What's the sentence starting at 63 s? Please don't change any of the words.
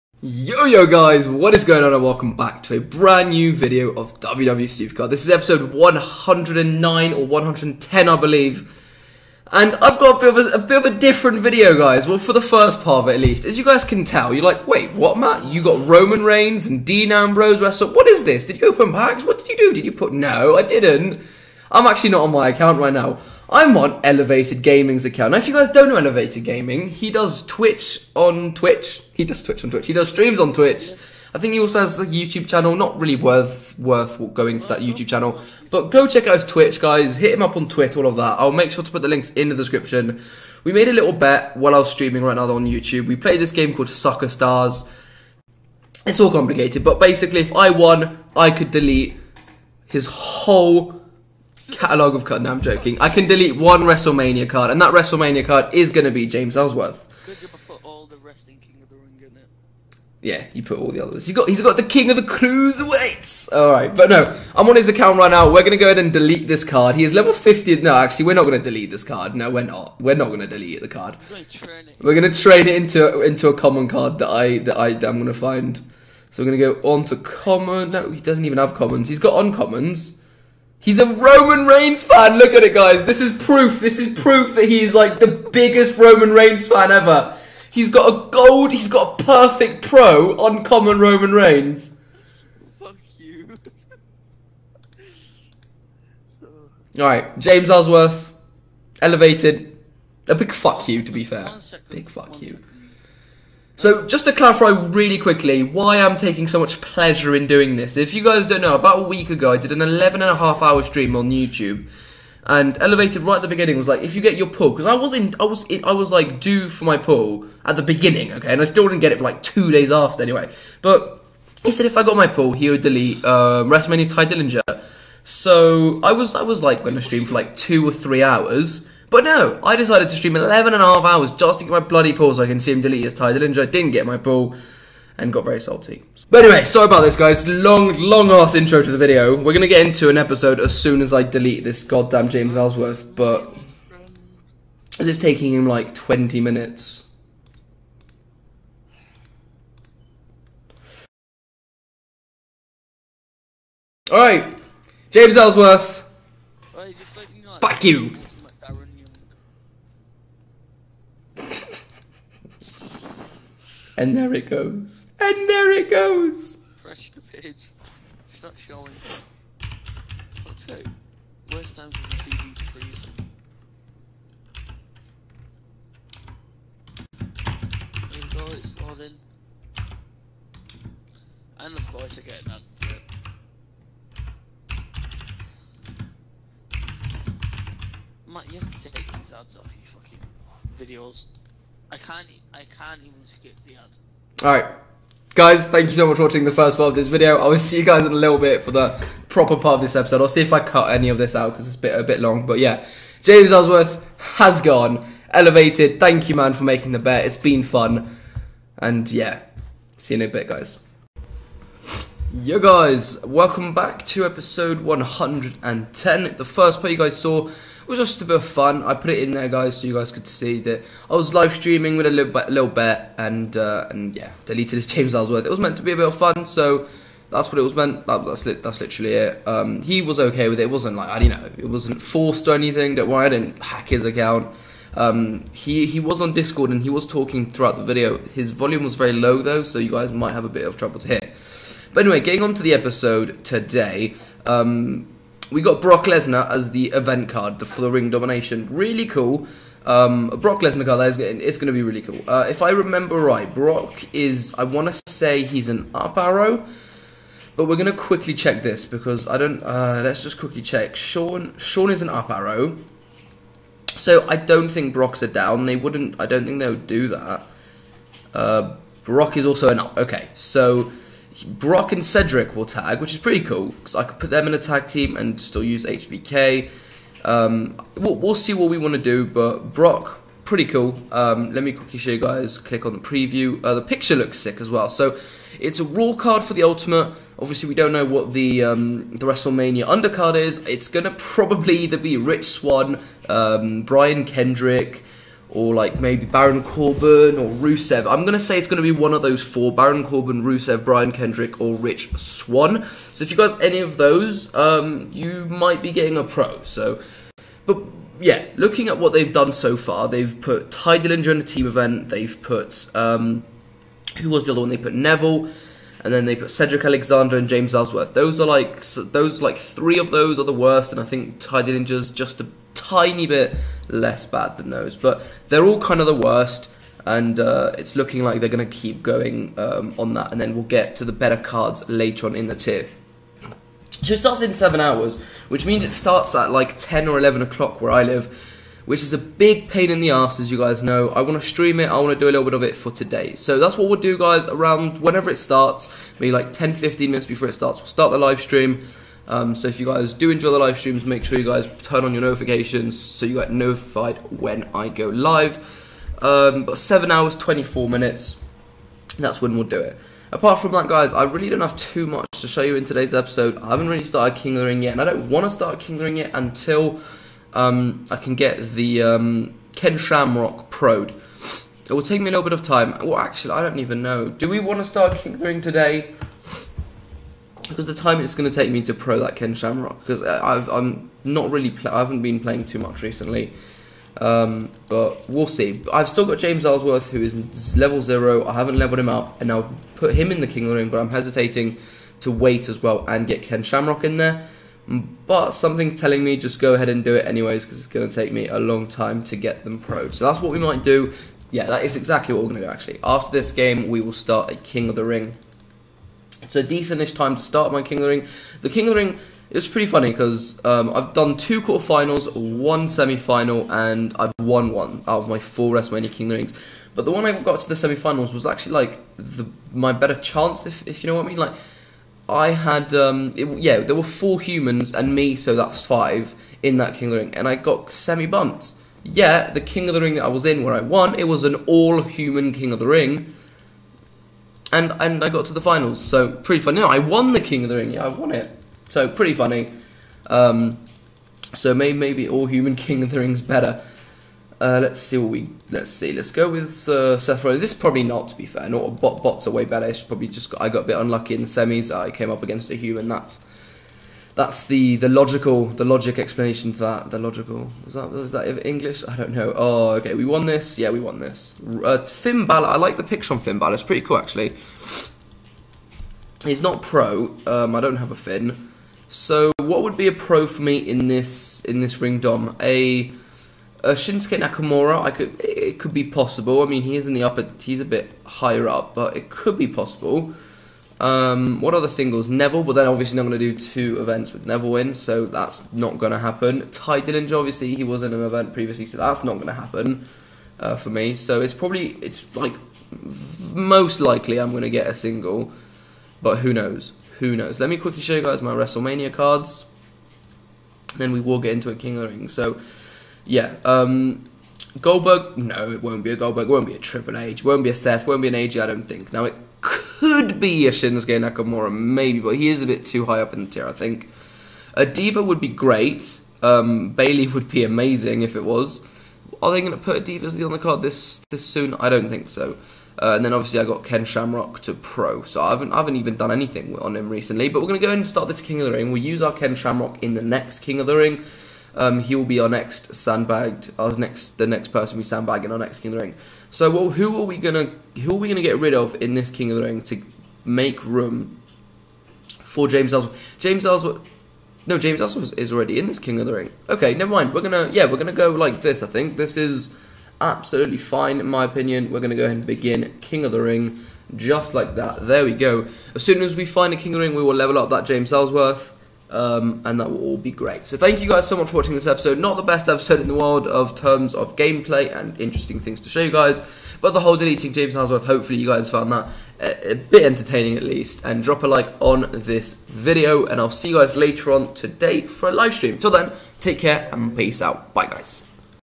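All right, but no, I'm on his account right now.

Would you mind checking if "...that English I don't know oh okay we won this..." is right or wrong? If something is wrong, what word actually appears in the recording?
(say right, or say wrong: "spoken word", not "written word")
right.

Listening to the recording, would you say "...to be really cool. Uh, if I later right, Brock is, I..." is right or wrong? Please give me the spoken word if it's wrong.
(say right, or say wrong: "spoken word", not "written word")
wrong: "remember", not "later".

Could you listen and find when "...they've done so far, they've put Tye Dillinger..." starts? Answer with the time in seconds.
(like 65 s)
309 s.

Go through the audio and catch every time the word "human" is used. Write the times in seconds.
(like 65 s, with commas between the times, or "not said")
424 s, 431 s, 442 s, 452 s.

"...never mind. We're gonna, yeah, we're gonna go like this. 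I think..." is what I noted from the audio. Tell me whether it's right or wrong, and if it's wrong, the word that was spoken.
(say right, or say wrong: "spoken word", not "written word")
right.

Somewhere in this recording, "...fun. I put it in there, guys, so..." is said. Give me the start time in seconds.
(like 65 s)
218 s.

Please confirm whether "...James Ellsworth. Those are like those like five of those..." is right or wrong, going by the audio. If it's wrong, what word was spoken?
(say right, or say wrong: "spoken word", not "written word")
wrong: "three", not "five".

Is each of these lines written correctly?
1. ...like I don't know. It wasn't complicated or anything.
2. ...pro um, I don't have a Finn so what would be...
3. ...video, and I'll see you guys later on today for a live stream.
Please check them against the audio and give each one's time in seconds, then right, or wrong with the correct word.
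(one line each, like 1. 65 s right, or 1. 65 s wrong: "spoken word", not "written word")
1. 230 s wrong: "forced", not "complicated"
2. 466 s right
3. 572 s right.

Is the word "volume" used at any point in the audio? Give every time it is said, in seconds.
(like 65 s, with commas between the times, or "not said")
238 s.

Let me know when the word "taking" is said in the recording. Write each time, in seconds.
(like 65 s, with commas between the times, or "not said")
106 s, 145 s.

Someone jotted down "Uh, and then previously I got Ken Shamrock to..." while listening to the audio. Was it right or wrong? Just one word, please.
wrong.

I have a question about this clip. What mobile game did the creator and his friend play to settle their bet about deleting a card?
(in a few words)
Soccer Stars.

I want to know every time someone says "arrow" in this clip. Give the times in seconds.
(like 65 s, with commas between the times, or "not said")
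256 s, 262 s.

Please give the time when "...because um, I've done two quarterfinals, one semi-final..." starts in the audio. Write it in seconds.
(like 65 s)
410 s.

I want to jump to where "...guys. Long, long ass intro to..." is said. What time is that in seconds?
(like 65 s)
137 s.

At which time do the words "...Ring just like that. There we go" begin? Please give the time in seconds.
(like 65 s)
553 s.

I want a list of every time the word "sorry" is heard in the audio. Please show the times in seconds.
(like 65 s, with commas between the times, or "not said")
136 s.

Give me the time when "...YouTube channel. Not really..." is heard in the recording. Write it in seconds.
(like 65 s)
32 s.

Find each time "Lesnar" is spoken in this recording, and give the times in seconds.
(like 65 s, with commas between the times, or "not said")
246 s, 250 s.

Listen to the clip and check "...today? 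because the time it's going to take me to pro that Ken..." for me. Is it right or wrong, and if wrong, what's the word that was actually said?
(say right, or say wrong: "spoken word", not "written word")
right.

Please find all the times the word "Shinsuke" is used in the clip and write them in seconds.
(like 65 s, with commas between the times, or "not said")
473 s, 510 s.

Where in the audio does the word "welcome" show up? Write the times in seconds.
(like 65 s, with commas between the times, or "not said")
2 s, 213 s.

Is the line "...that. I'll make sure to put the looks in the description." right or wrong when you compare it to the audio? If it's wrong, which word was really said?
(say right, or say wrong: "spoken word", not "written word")
wrong: "links", not "looks".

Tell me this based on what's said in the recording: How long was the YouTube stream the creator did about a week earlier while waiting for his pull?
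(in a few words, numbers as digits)
11 and a half hours.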